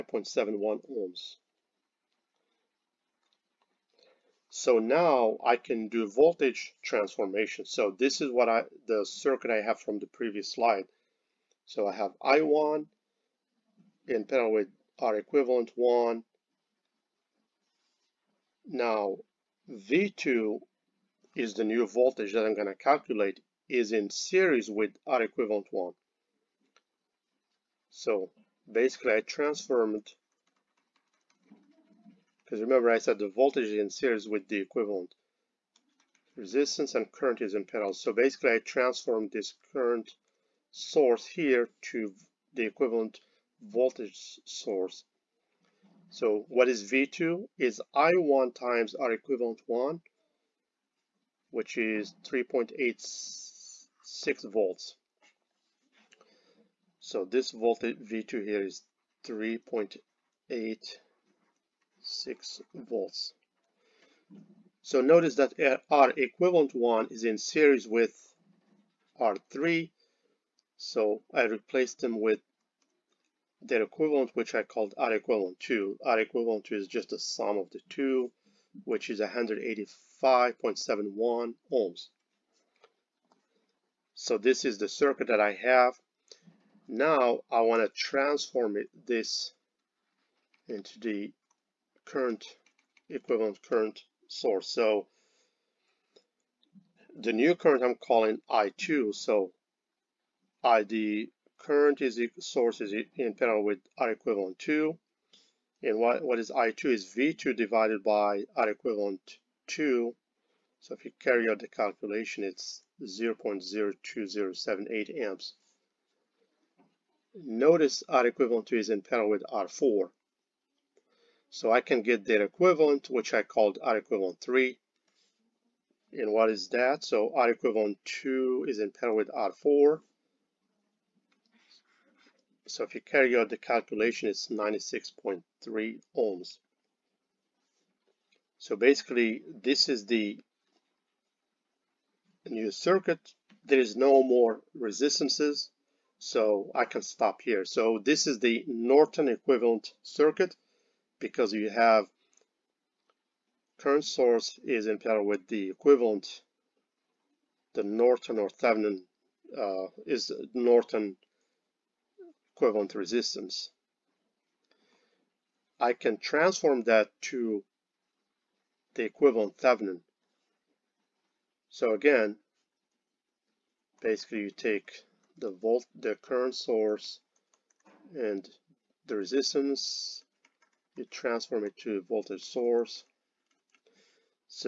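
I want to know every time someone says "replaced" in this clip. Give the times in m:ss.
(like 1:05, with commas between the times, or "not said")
1:11.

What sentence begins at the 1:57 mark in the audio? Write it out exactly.
Notice R equivalent 2 is in parallel with R4.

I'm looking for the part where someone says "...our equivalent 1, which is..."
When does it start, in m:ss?
0:48.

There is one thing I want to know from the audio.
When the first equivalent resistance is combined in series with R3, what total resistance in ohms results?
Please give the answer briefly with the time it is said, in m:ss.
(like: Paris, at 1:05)
185.71 ohms, at 1:19.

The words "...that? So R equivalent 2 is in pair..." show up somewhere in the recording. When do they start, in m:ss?
2:06.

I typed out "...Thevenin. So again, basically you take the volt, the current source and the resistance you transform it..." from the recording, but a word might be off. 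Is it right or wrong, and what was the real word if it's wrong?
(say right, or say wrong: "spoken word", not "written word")
right.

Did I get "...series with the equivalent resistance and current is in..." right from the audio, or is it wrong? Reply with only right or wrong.
right.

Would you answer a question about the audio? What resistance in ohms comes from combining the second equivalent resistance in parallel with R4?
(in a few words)
96.3 ohms.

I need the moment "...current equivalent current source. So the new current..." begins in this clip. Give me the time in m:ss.
1:32.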